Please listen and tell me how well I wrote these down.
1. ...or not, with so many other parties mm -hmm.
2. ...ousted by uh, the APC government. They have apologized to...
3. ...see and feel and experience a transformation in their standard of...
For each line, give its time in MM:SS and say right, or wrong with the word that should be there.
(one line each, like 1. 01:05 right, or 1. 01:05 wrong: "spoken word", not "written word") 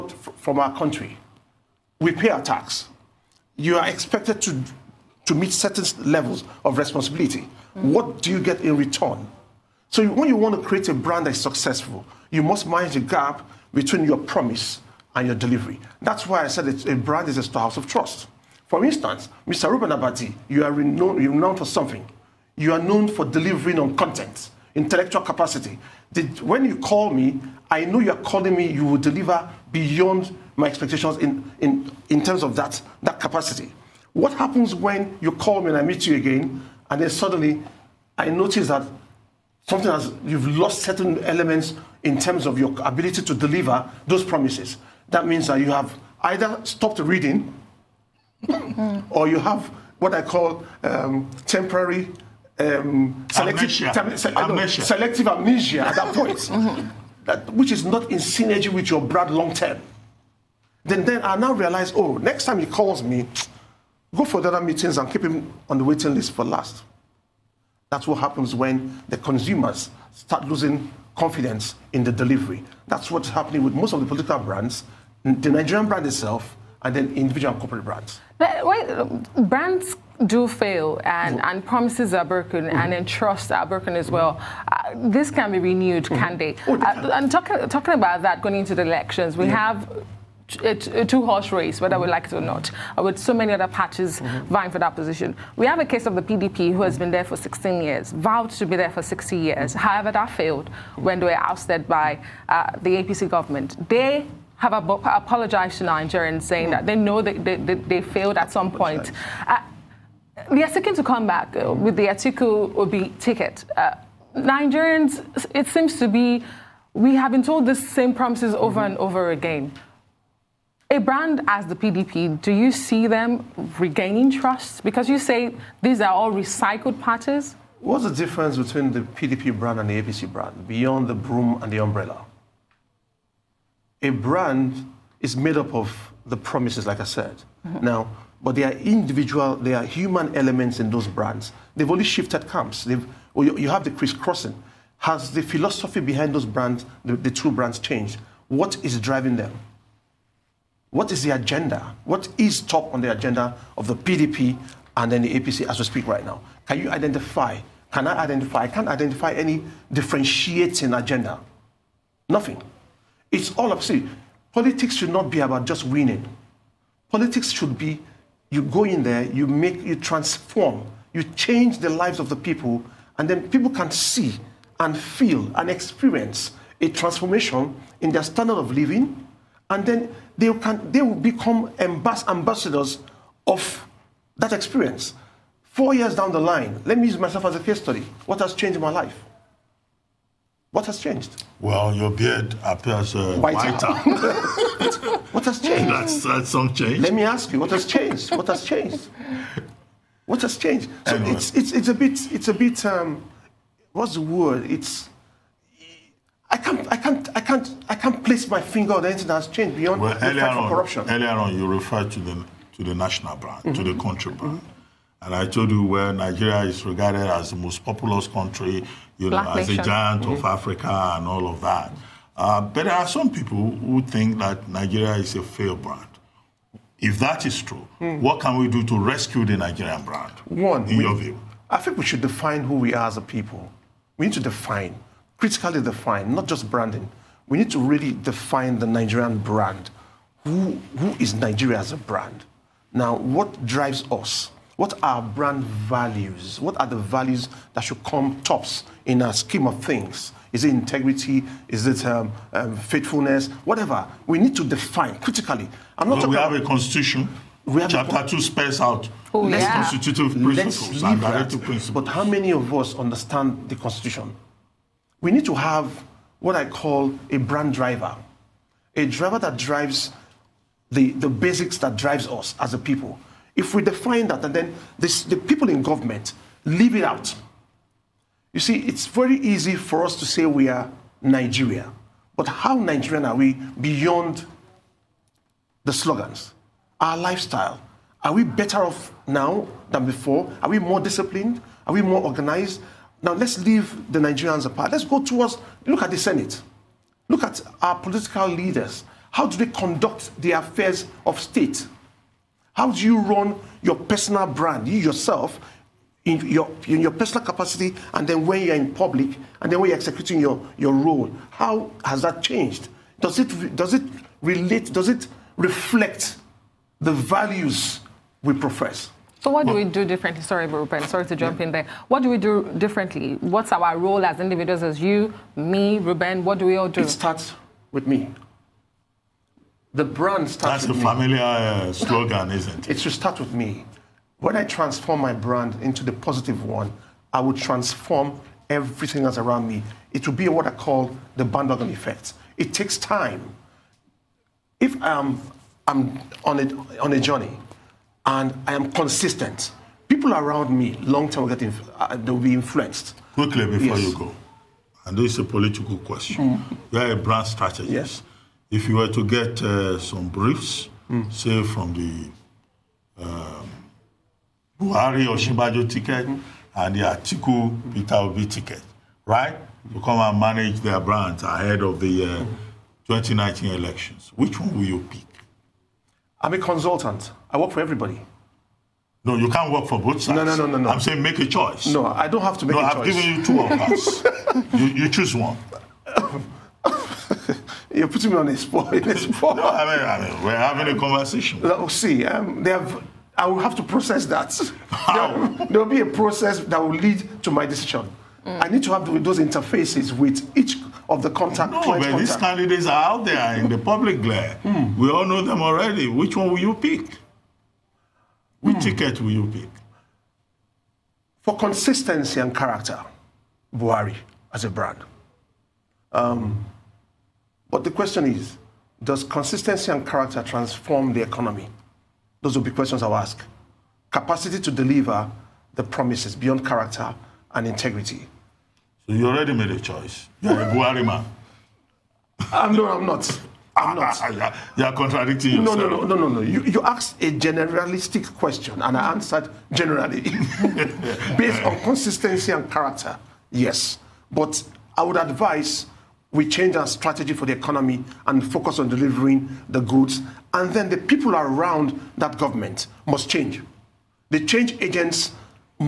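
1. 01:32 right
2. 01:41 right
3. 02:53 right.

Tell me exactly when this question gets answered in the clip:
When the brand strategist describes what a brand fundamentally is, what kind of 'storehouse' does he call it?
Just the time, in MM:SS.
00:17.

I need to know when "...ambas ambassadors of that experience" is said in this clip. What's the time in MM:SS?
03:01.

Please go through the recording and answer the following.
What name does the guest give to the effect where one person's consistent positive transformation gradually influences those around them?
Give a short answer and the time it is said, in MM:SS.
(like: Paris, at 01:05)
bandwagon effect, at 05:41.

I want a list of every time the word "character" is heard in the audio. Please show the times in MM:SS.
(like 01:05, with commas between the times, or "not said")
06:52, 07:00, 07:06, 07:22.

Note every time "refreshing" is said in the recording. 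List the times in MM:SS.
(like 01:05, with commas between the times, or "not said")
not said.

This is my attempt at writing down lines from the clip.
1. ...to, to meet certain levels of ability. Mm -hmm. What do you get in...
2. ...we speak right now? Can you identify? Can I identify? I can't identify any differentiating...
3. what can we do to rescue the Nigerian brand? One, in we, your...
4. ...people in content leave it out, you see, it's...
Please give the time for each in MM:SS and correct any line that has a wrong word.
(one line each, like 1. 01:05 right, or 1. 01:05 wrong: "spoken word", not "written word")
1. 00:04 wrong: "responsibility", not "ability"
2. 02:35 right
3. 03:48 right
4. 04:35 wrong: "government", not "content".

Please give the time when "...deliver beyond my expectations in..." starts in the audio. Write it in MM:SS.
00:28.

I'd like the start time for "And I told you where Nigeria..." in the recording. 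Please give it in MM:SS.
03:35.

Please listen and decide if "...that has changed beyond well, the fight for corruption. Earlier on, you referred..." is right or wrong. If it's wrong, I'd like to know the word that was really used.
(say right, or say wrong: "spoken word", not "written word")
right.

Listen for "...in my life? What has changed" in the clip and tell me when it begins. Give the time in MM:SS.
03:08.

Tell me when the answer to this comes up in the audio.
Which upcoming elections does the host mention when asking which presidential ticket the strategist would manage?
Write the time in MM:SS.
06:13.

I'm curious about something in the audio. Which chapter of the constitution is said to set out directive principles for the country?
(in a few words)
Chapter 2.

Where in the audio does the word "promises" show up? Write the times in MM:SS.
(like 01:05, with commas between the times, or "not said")
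00:14, 00:44, 01:21, 01:58, 02:16, 07:05.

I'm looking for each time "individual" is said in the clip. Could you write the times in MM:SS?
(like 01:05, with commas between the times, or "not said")
01:17, 02:18, 05:24.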